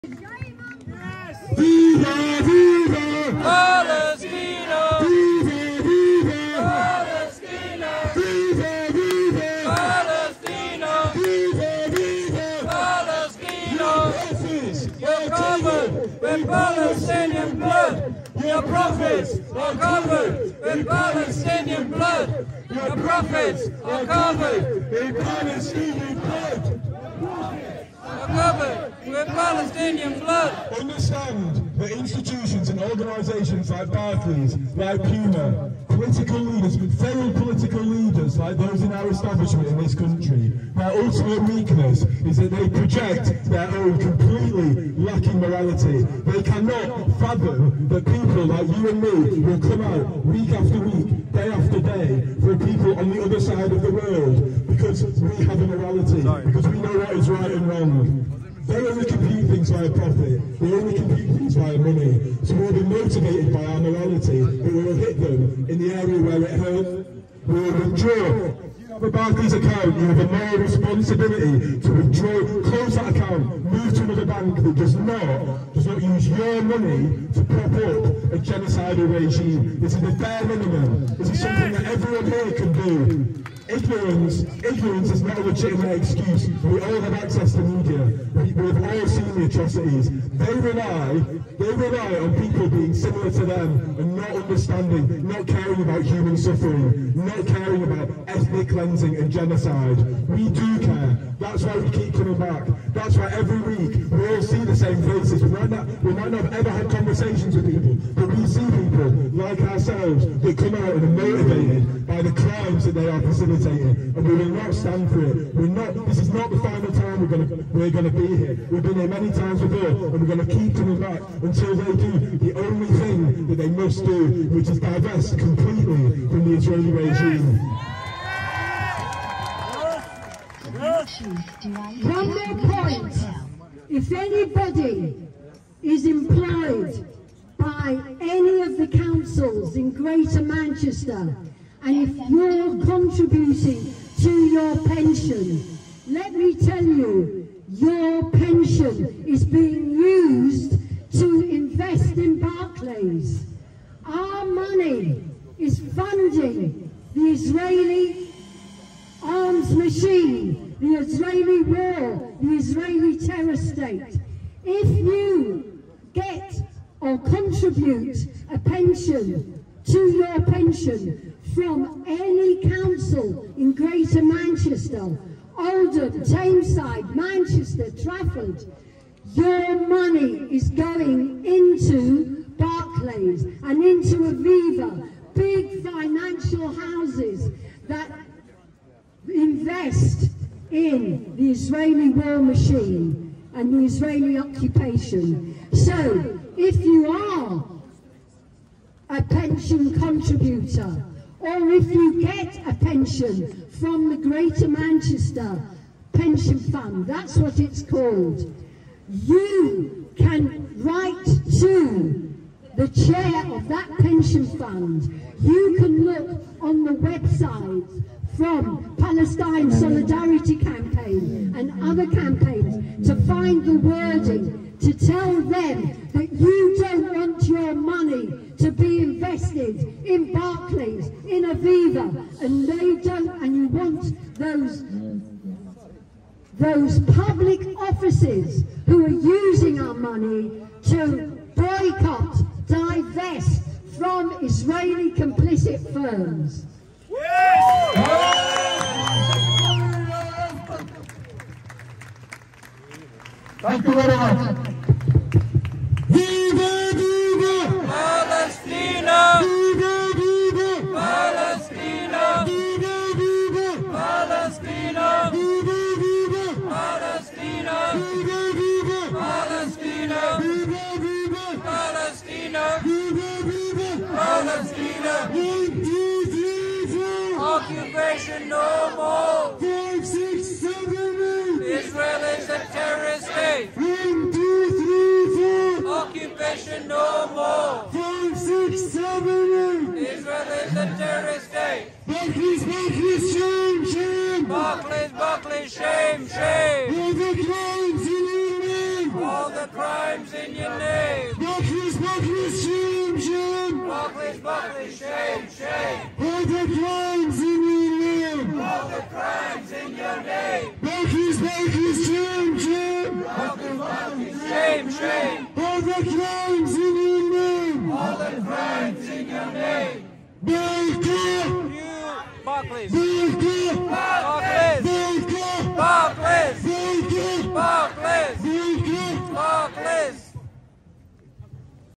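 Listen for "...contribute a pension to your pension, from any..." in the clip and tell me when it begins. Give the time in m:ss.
2:47.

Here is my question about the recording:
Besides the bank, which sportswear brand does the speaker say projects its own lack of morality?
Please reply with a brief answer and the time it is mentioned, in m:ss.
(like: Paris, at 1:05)
Puma, at 0:35.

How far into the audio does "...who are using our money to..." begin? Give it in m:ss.
3:58.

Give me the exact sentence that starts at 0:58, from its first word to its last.
They only compute things via profit.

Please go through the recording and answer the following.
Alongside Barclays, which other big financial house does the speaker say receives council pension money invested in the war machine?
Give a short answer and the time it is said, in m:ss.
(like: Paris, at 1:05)
Aviva, at 3:04.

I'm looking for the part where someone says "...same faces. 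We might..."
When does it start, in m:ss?
1:44.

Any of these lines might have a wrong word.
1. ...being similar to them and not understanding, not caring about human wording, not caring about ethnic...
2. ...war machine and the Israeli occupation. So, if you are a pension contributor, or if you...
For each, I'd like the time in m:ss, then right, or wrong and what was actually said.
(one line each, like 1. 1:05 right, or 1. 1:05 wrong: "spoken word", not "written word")
1. 1:32 wrong: "suffering", not "wording"
2. 3:12 right.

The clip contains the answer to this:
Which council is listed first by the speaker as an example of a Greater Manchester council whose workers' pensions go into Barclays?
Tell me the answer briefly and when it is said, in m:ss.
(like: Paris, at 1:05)
Oldham, at 2:55.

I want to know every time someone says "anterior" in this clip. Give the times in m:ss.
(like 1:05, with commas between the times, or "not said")
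not said.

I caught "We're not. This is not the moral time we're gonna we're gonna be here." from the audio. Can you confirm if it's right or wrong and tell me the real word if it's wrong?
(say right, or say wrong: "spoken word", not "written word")
wrong: "final", not "moral".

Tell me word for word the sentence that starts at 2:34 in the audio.
Our money is funding the Israeli arms machine, the Israeli war, the Israeli terror state.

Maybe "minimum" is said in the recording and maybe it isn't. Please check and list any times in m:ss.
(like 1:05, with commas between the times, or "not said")
1:20.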